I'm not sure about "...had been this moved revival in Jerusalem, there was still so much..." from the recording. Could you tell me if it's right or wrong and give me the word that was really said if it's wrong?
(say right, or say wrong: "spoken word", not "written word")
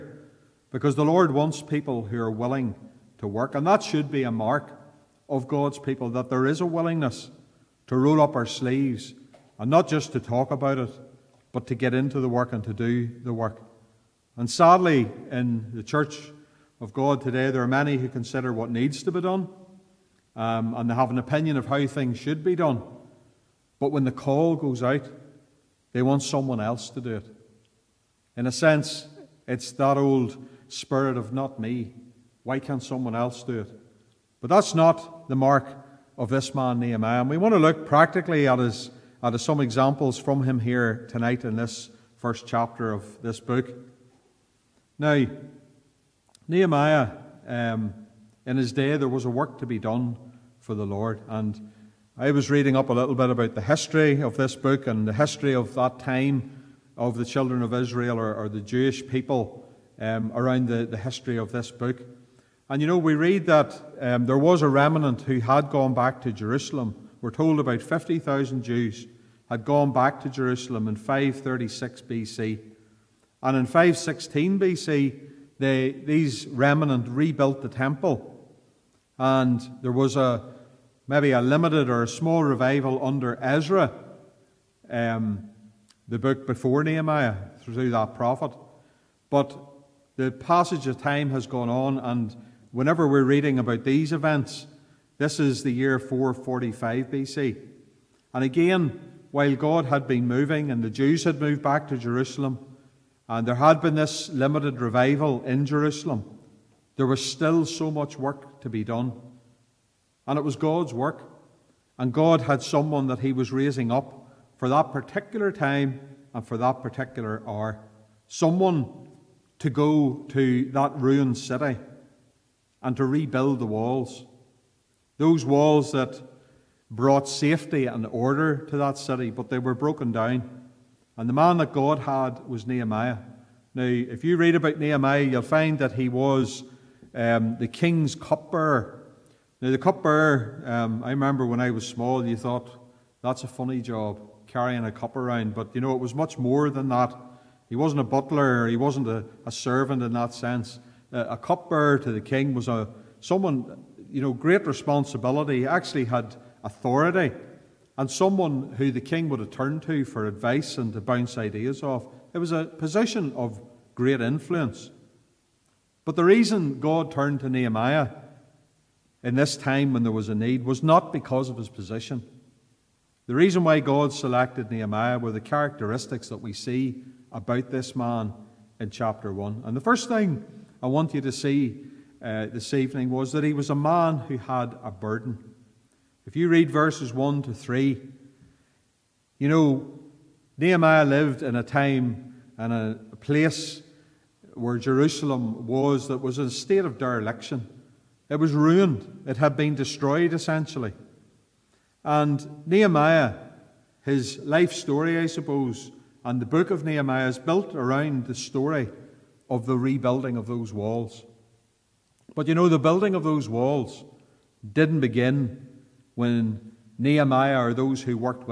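wrong: "limited", not "moved".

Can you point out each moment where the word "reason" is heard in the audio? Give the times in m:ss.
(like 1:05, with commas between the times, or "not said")
2:46, 2:53.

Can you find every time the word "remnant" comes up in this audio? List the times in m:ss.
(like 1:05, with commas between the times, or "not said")
1:04, 1:16.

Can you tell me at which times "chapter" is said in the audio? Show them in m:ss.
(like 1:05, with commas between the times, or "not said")
0:42, 2:58.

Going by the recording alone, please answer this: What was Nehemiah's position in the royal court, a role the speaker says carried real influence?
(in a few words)
King's cupbearer.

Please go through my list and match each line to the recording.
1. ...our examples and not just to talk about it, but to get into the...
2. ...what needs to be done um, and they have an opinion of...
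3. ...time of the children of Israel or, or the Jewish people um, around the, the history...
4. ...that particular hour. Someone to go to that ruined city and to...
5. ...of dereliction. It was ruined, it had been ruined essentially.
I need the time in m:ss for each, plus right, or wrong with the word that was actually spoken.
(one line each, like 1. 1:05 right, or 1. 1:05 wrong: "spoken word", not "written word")
1. 0:08 wrong: "sleeves", not "examples"
2. 0:18 right
3. 0:55 right
4. 1:56 right
5. 3:16 wrong: "destroyed", not "ruined".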